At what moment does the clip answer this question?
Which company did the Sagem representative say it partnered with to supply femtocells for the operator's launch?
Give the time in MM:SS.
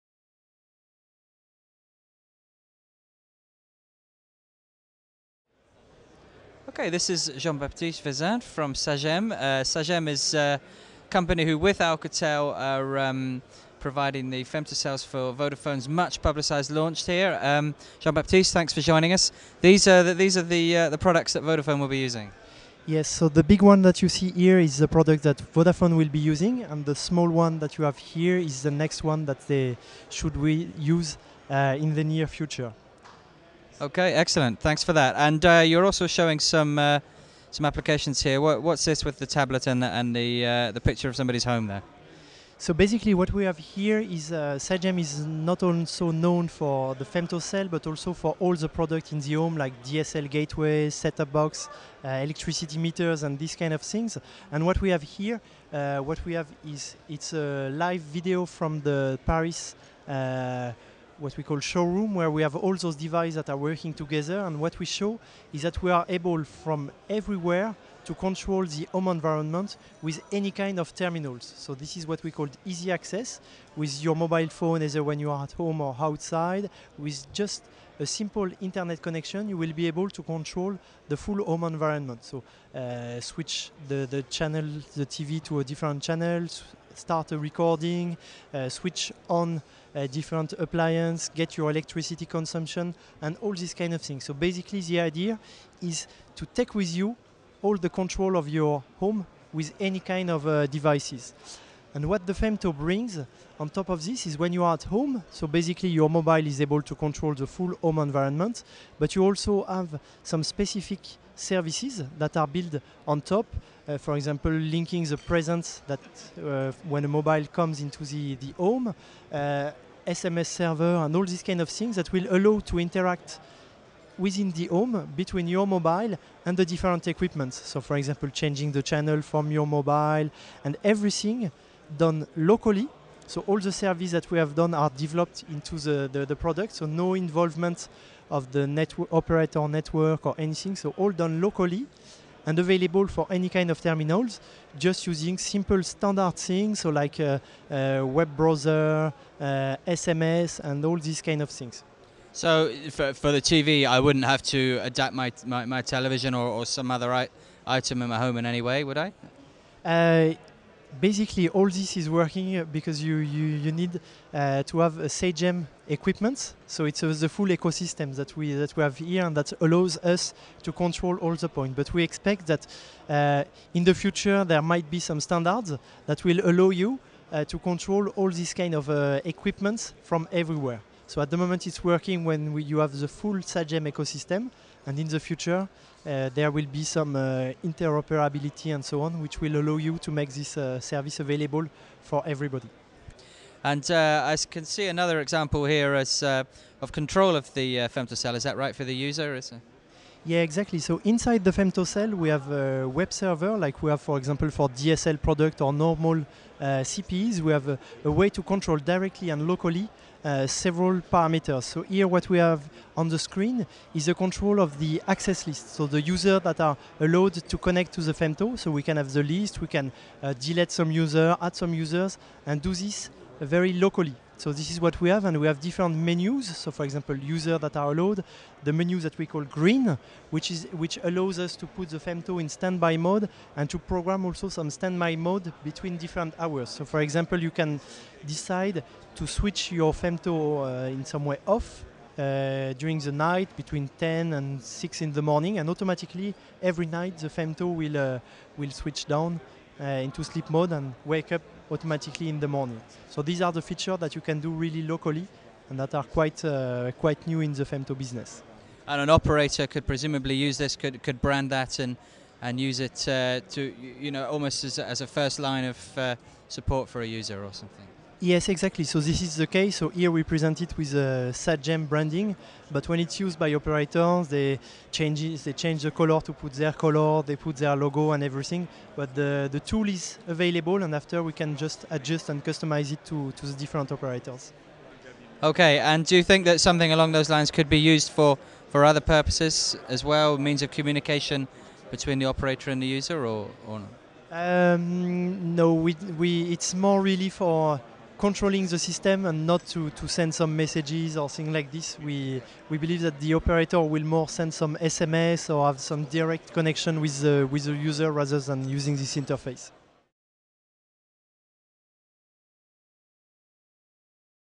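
00:11.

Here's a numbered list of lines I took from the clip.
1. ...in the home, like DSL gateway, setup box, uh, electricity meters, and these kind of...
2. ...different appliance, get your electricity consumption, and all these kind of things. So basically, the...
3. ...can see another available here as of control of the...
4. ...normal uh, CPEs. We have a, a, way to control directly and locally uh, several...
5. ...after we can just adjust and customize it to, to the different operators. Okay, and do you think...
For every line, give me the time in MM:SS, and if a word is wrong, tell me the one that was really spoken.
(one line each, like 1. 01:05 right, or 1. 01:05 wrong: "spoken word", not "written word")
1. 00:49 right
2. 01:30 right
3. 03:14 wrong: "example", not "available"
4. 03:25 right
5. 04:40 right.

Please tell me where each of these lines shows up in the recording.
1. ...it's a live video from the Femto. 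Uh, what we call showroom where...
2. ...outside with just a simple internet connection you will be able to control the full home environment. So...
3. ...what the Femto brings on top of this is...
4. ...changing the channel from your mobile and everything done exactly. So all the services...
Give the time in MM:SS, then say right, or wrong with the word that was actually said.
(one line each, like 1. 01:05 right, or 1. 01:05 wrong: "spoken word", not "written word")
1. 00:57 wrong: "Paris", not "Femto"
2. 01:15 right
3. 01:42 right
4. 02:08 wrong: "locally", not "exactly".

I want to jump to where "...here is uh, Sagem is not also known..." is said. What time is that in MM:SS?
00:43.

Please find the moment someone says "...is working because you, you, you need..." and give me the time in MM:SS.
02:41.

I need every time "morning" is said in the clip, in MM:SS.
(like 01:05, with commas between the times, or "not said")
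04:05, 04:12.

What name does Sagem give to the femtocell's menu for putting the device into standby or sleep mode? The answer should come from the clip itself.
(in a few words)
green.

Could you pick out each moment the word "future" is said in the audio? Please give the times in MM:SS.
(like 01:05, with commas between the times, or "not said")
00:32, 02:53, 03:05.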